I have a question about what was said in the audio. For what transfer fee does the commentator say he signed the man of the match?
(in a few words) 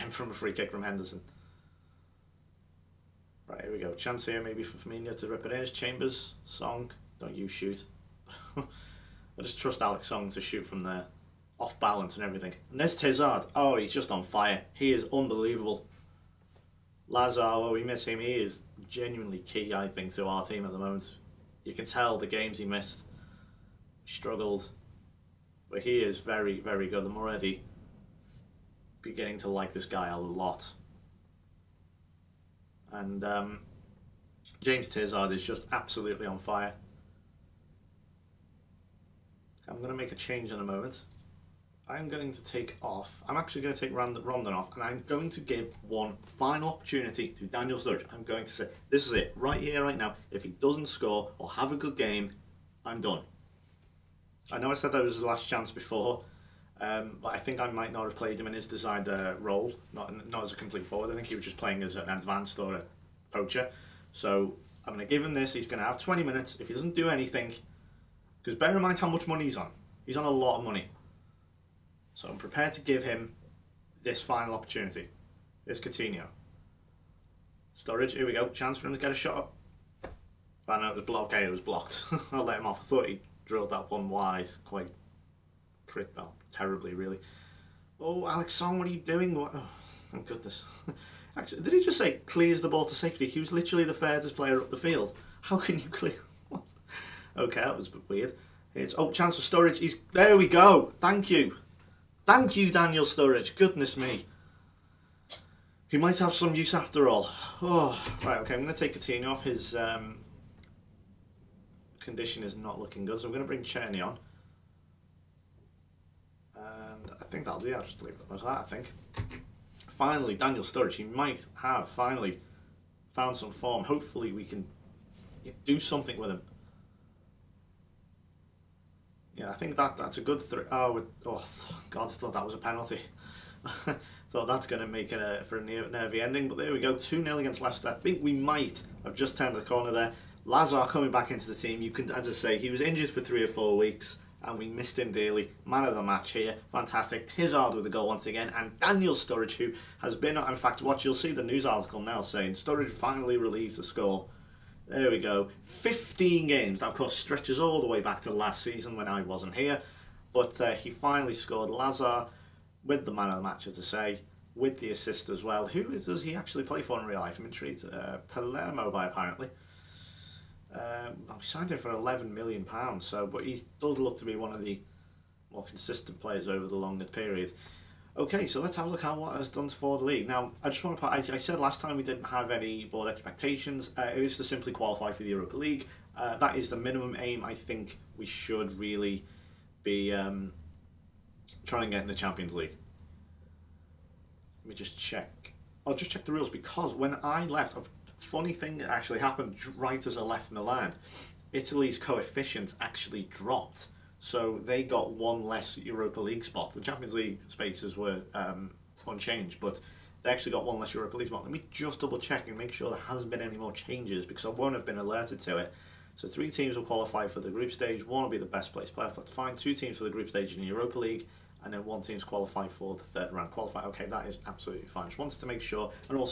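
£11 million.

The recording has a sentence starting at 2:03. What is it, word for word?
Hopefully we can do something with him yeah, I think that that's a good three.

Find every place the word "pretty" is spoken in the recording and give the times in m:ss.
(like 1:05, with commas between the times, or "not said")
1:25.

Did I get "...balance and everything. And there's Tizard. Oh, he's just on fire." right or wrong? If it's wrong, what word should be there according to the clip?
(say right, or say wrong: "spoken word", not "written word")
right.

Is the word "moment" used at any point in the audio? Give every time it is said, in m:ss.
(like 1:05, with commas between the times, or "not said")
0:20, 0:40.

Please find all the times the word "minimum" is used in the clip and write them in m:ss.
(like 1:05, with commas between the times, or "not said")
3:06.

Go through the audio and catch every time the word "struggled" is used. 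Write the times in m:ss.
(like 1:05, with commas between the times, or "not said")
0:24.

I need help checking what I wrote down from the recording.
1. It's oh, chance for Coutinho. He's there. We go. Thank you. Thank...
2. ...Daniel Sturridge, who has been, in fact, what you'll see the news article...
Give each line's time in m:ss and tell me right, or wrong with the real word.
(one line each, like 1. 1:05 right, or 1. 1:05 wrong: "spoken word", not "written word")
1. 1:38 wrong: "Sturridge", not "Coutinho"
2. 2:28 right.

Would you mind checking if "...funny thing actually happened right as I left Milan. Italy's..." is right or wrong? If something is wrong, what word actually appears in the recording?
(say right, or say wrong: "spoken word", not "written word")
right.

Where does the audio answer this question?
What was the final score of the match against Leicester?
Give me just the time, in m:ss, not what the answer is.
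2:16.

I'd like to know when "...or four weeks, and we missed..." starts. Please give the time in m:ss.
2:23.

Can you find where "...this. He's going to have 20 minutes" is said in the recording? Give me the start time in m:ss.
1:05.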